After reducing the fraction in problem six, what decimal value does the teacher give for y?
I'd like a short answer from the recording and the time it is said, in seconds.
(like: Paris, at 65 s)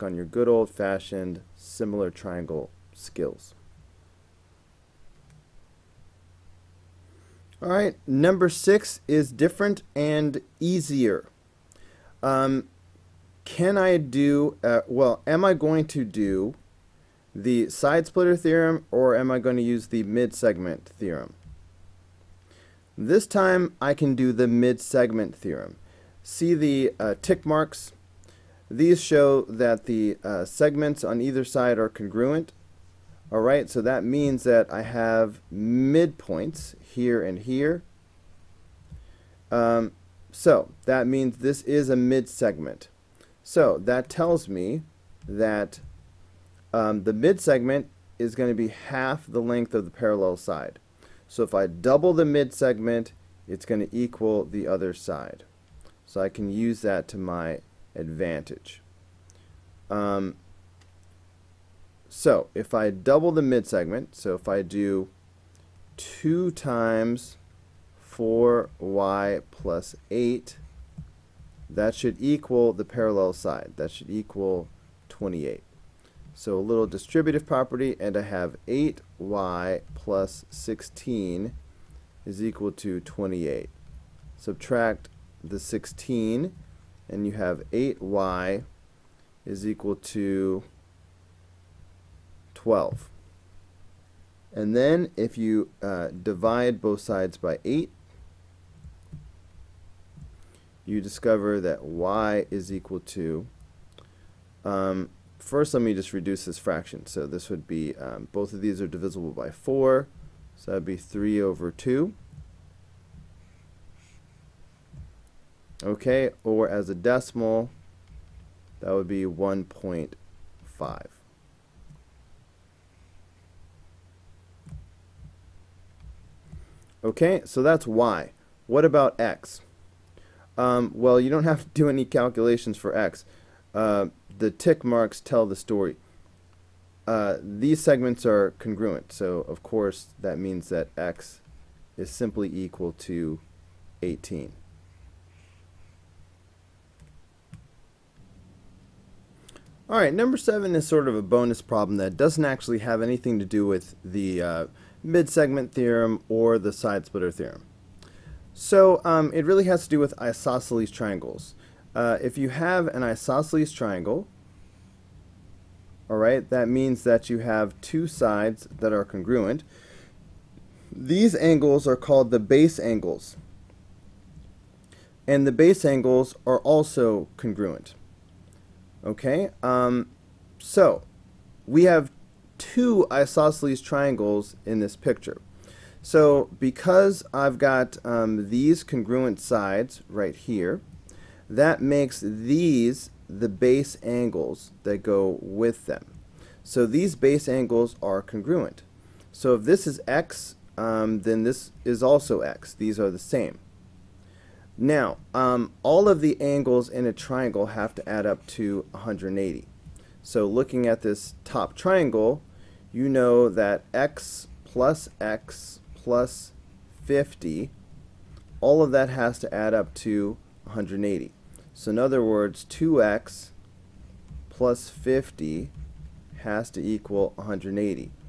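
1.5, at 119 s.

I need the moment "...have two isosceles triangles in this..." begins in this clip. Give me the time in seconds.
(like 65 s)
181 s.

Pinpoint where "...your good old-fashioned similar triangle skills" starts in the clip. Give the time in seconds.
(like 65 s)
0 s.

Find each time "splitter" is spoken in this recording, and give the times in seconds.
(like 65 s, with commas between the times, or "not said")
18 s, 157 s.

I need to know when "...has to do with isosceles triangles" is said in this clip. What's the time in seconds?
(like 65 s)
159 s.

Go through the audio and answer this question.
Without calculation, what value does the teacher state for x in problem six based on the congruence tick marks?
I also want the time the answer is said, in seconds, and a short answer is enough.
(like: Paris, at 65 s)
18, at 144 s.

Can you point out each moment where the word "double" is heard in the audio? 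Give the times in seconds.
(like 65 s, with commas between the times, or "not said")
51 s, 62 s.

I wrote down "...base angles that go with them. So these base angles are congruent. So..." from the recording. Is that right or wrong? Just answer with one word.
right.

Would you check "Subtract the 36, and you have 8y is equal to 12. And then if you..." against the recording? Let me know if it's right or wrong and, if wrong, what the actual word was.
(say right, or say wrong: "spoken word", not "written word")
wrong: "16", not "36".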